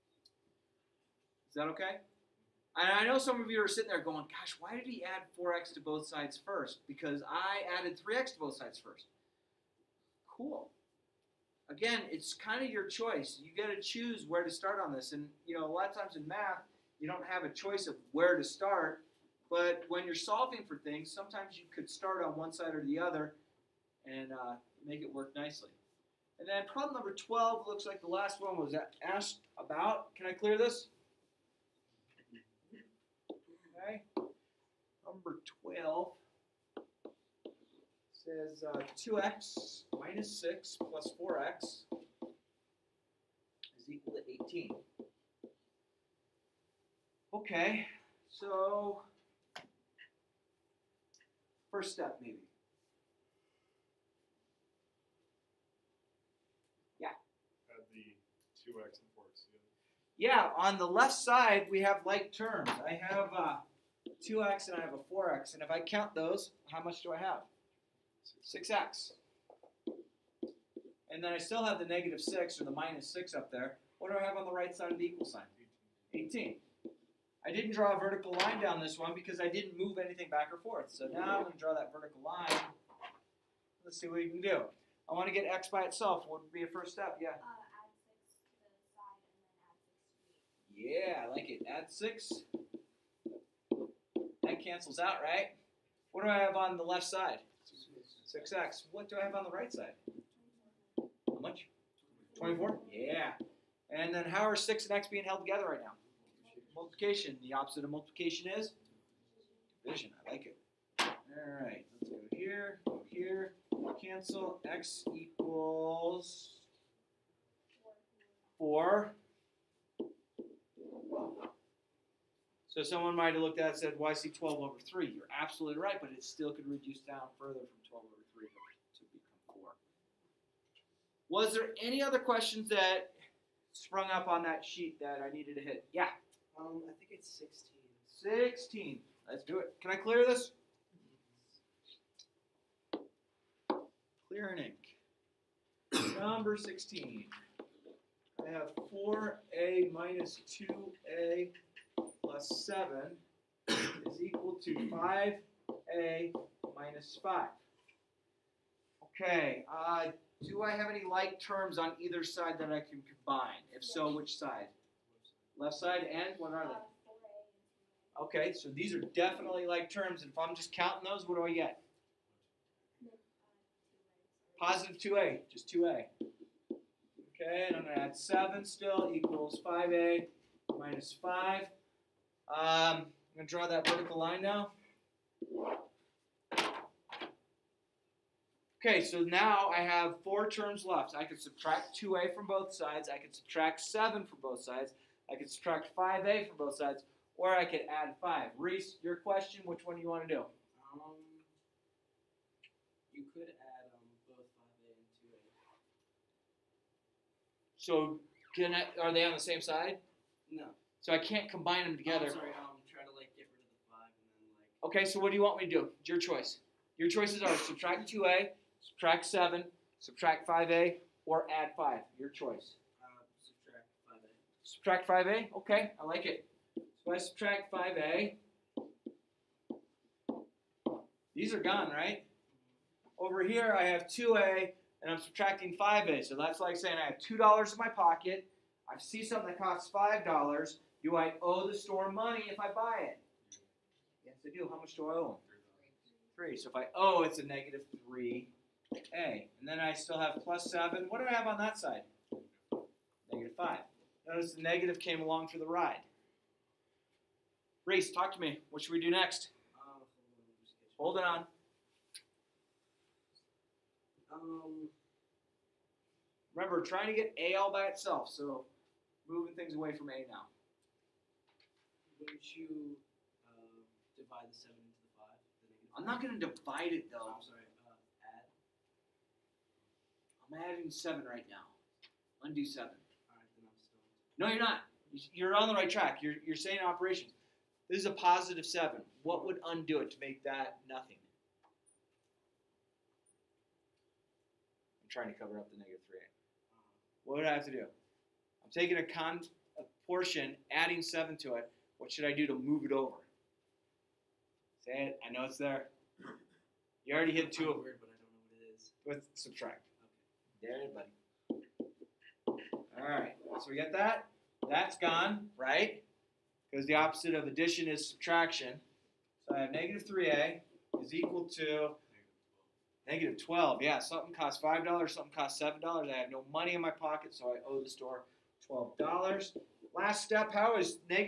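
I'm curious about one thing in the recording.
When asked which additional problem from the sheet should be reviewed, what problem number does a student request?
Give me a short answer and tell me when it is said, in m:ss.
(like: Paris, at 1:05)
16, at 2:16.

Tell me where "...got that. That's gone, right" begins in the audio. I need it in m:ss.
5:13.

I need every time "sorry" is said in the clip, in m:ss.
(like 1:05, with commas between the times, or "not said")
3:32, 4:37.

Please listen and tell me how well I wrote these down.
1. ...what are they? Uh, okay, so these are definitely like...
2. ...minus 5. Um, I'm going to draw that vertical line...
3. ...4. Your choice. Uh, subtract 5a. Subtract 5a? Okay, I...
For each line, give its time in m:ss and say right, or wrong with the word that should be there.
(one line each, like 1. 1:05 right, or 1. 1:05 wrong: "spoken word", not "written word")
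1. 2:46 right
2. 3:00 right
3. 3:41 wrong: "5", not "4".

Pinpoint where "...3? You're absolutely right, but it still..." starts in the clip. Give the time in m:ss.
2:04.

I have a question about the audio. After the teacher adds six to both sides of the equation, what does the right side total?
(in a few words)
24.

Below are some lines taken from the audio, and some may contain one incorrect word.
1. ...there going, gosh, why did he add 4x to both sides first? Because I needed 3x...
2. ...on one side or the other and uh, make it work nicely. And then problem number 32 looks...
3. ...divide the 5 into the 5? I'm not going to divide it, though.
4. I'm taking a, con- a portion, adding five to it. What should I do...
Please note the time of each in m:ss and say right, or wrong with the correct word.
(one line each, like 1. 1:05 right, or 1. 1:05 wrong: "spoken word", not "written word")
1. 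0:03 wrong: "added", not "needed"
2. 0:22 wrong: "12", not "32"
3. 4:34 wrong: "7", not "5"
4. 4:57 wrong: "seven", not "five".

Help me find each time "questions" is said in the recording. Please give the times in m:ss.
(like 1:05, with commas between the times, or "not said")
2:12, 3:19.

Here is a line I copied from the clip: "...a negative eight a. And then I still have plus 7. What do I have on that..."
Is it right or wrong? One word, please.
wrong.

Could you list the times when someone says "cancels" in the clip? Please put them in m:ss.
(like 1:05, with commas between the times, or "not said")
1:34, 1:54.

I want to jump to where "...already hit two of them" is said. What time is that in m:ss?
5:07.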